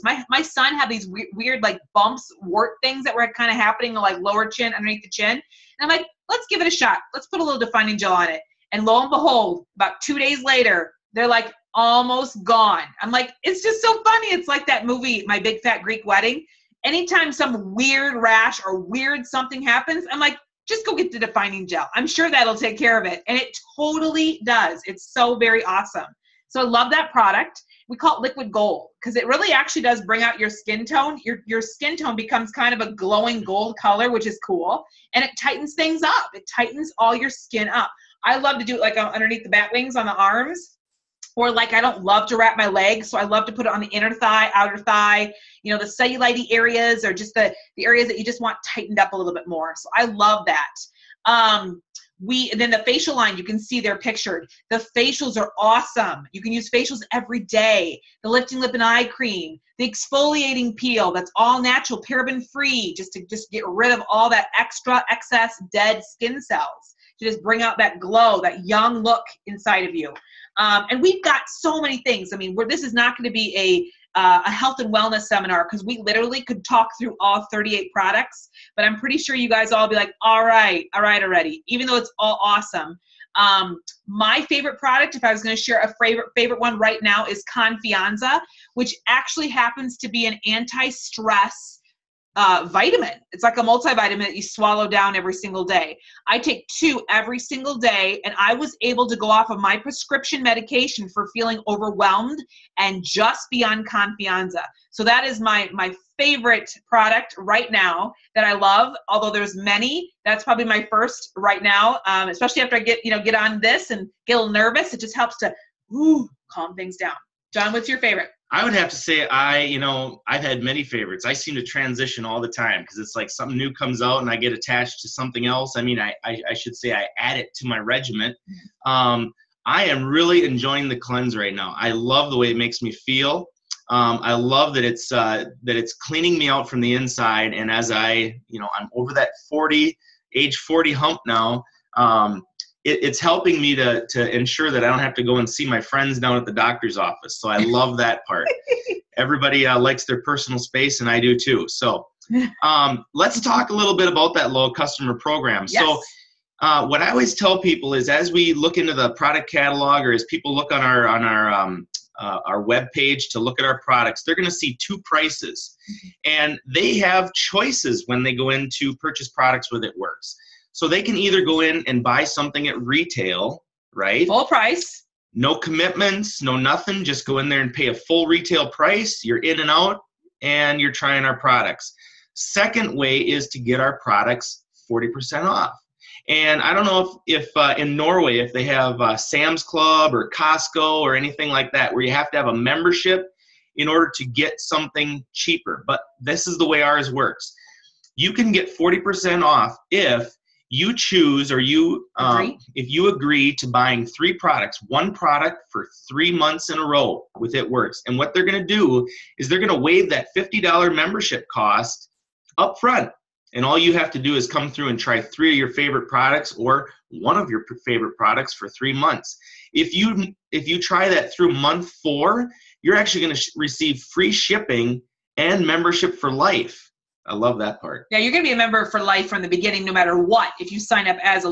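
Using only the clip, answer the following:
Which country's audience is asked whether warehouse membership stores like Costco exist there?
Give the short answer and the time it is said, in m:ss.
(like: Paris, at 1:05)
Norway, at 3:07.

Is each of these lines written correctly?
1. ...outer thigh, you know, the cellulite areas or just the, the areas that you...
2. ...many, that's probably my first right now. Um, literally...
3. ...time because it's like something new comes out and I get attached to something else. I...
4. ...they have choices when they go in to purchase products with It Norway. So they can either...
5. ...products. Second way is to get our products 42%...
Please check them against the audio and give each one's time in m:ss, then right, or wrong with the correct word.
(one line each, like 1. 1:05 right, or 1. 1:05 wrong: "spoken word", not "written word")
1. 0:44 right
2. 1:49 wrong: "especially", not "literally"
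3. 2:02 right
4. 2:46 wrong: "Works", not "Norway"
5. 3:01 wrong: "40", not "42".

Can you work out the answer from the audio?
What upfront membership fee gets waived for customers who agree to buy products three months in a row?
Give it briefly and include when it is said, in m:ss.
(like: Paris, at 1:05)
$50, at 3:30.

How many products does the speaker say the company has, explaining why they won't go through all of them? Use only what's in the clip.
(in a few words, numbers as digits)
38.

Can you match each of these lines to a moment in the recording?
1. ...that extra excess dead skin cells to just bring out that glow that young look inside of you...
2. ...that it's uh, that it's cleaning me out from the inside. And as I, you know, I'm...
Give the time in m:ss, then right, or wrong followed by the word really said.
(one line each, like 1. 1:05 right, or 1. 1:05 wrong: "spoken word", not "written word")
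1. 1:04 right
2. 2:14 right.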